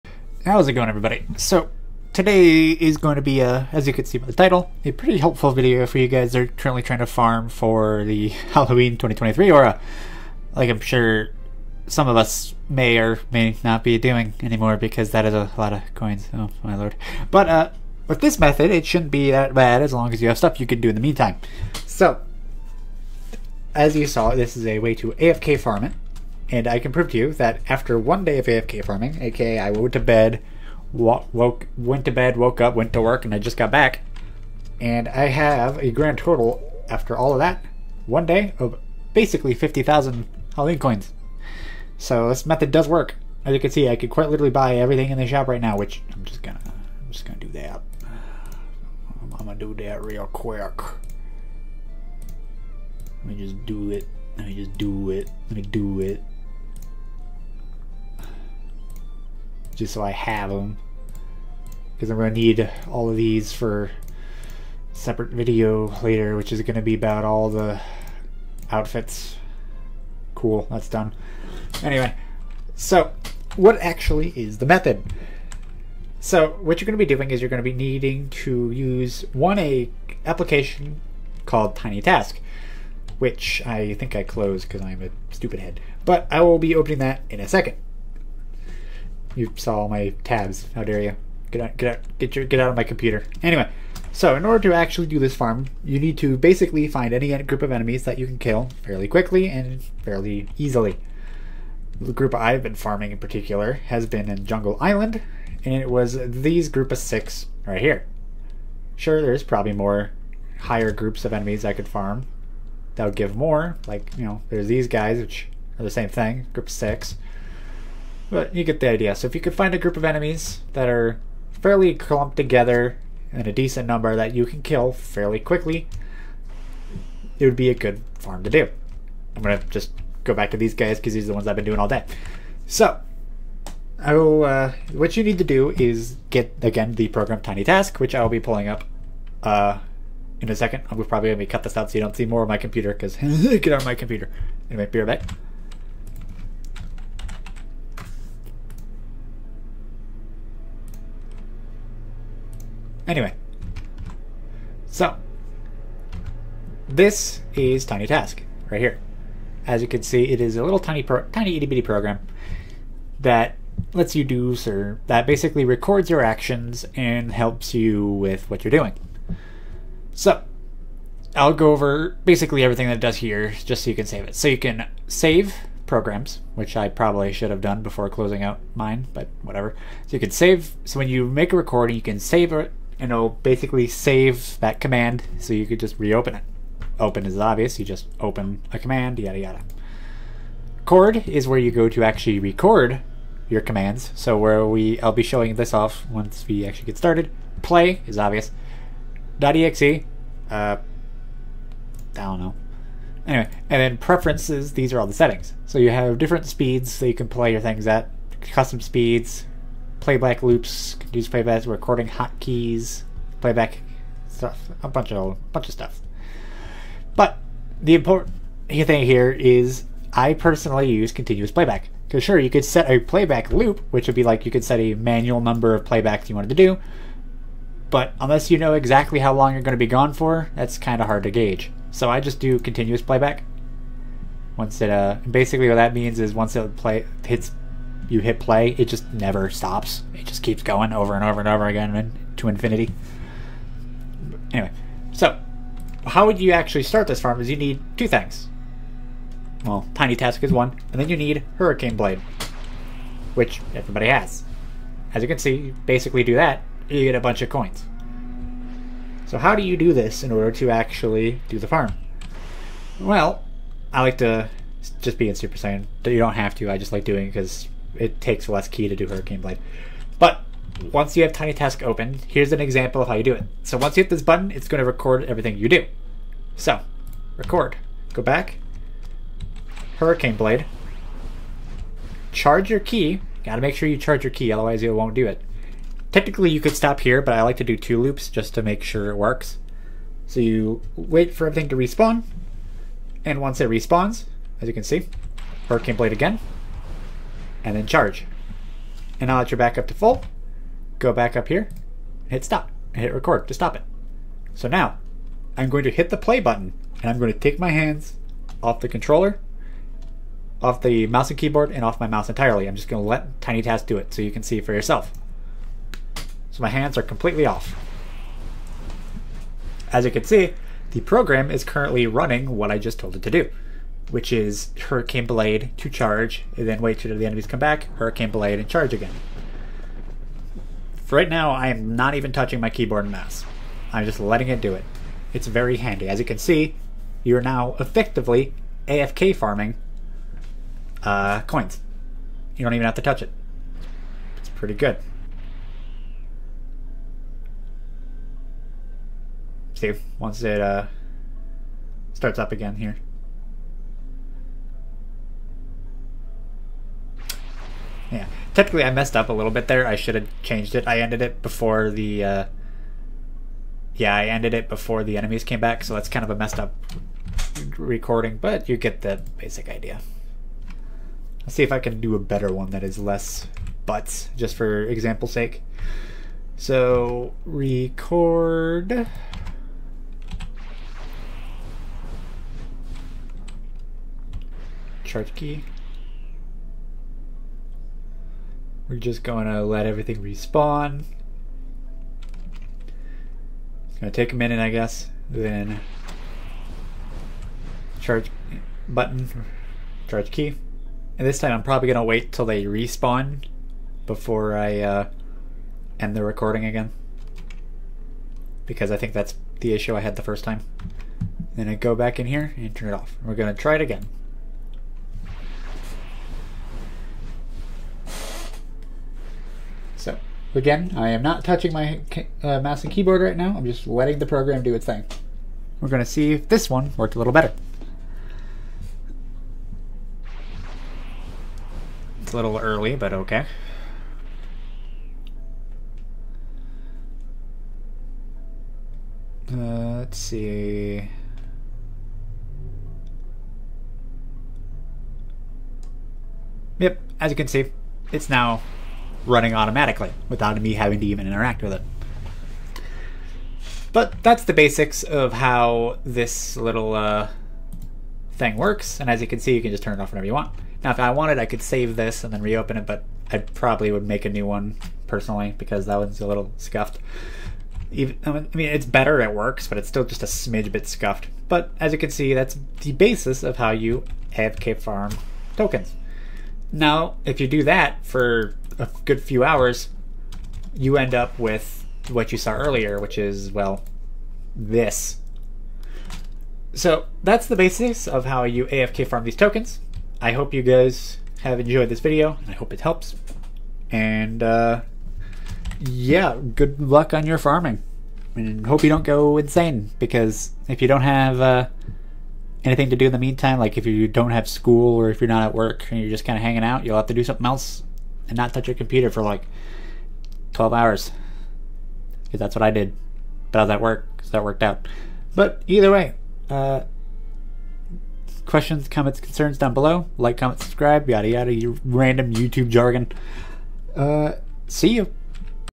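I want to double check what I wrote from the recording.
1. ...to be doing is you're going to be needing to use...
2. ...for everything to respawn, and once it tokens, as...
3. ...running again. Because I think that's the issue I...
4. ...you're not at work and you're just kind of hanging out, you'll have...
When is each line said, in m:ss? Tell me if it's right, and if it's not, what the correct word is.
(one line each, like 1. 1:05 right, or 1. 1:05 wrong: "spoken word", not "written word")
1. 1:16 right
2. 4:51 wrong: "respawns", not "tokens"
3. 6:46 wrong: "recording", not "running"
4. 8:25 right.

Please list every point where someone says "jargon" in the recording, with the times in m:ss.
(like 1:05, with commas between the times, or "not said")
8:42.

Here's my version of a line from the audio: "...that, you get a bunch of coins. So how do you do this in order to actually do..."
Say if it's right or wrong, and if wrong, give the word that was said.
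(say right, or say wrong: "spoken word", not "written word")
right.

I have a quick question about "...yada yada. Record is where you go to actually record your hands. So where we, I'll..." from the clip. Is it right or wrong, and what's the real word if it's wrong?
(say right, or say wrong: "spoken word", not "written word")
wrong: "commands", not "hands".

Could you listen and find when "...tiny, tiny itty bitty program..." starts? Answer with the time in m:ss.
2:40.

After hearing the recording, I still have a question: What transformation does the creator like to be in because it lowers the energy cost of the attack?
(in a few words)
Super Saiyan.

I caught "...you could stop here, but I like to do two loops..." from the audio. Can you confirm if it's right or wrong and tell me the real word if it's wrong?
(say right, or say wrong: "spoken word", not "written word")
right.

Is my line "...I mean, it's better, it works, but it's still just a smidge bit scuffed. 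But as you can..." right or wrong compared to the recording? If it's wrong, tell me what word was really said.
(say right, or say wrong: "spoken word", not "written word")
right.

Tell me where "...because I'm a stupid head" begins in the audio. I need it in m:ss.
1:24.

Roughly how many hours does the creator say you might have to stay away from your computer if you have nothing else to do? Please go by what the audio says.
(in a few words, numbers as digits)
12 hours.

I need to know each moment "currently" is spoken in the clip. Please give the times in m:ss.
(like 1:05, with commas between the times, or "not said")
0:06, 5:21.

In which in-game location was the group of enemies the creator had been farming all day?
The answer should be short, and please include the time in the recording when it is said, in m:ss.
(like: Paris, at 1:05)
Jungle Island, at 1:44.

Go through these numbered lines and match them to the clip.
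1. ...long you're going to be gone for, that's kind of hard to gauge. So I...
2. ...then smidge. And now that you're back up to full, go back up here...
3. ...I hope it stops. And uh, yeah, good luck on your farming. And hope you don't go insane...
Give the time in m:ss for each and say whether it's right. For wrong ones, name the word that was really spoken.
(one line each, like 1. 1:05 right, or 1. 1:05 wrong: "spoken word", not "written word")
1. 3:49 right
2. 4:57 wrong: "charge", not "smidge"
3. 8:12 wrong: "helps", not "stops".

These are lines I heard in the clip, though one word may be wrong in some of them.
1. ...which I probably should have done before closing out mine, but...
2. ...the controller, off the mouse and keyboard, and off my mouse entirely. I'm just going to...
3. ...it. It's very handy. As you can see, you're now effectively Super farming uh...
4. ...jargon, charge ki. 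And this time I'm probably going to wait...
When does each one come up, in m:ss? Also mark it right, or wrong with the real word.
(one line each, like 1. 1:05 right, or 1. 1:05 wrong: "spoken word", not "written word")
1. 2:56 right
2. 5:08 right
3. 5:34 wrong: "AFK", not "Super"
4. 6:38 wrong: "button", not "jargon".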